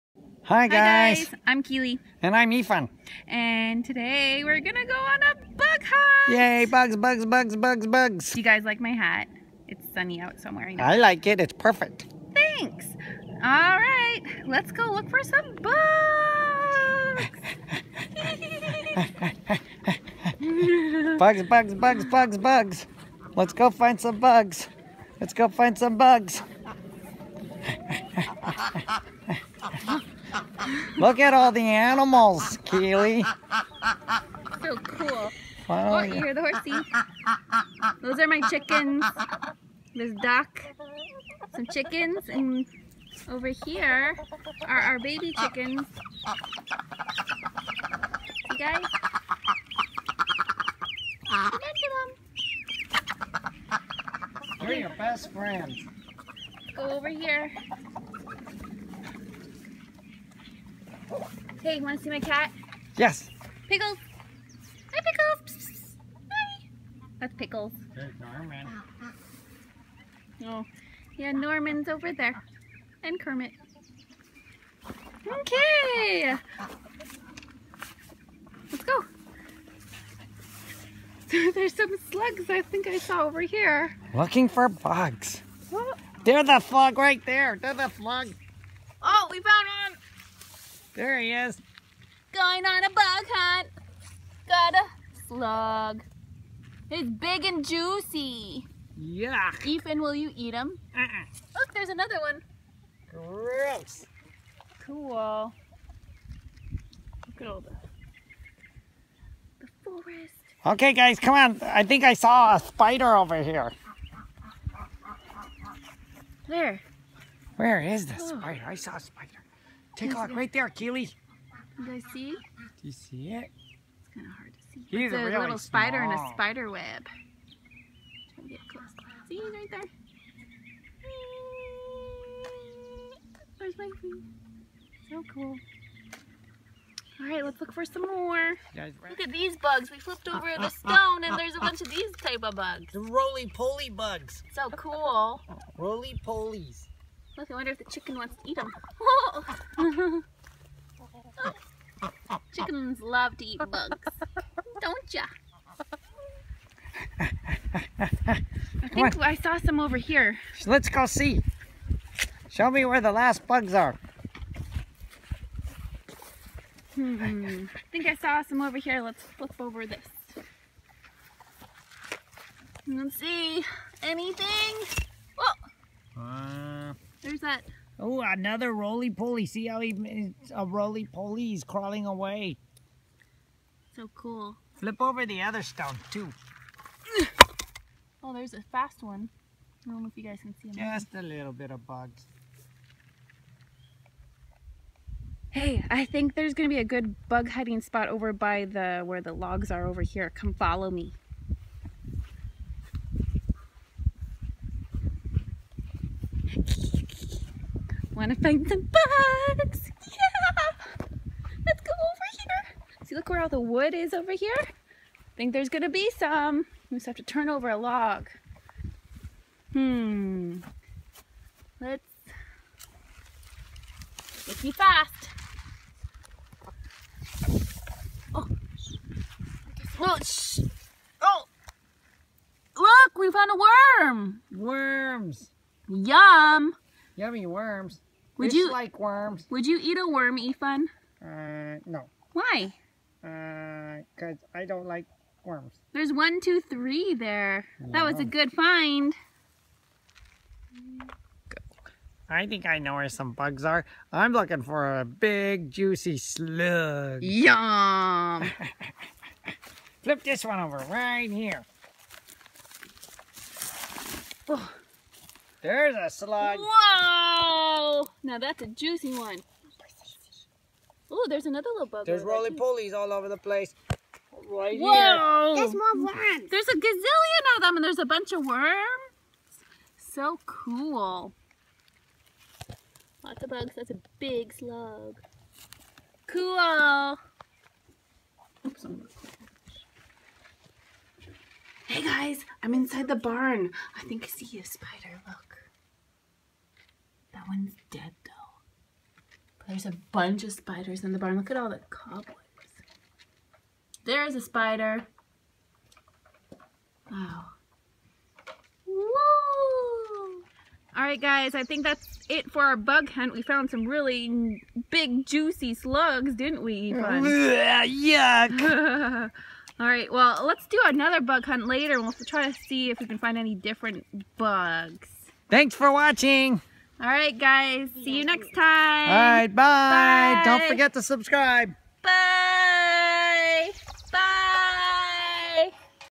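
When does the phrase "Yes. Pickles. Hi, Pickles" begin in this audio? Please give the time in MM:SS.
01:02.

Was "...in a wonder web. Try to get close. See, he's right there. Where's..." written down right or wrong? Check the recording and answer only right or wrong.
wrong.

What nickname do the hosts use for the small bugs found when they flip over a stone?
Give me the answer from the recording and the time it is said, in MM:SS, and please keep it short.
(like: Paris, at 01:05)
roly-poly bugs, at 02:22.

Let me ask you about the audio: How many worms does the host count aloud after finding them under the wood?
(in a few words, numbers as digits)
3.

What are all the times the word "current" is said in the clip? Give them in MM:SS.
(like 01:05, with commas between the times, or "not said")
not said.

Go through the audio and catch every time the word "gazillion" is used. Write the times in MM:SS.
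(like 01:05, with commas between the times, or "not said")
04:36.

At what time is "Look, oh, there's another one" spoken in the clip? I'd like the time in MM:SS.
01:41.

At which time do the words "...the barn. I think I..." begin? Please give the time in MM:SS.
04:53.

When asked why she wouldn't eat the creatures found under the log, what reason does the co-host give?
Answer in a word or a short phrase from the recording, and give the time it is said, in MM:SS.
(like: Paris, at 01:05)
I don't like worms, at 04:04.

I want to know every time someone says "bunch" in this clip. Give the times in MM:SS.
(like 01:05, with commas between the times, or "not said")
02:21, 04:38, 05:00.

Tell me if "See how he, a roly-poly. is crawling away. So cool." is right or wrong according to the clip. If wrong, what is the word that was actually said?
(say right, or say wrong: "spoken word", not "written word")
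right.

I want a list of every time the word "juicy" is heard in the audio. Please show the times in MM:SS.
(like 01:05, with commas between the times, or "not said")
01:37, 04:15, 04:28, 05:15.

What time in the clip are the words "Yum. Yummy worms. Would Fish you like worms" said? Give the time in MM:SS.
03:55.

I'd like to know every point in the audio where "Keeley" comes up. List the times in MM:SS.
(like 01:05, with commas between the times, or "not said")
00:01, 00:32, 02:00.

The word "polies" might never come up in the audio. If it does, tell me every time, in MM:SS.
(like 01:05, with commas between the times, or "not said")
02:25, 04:32.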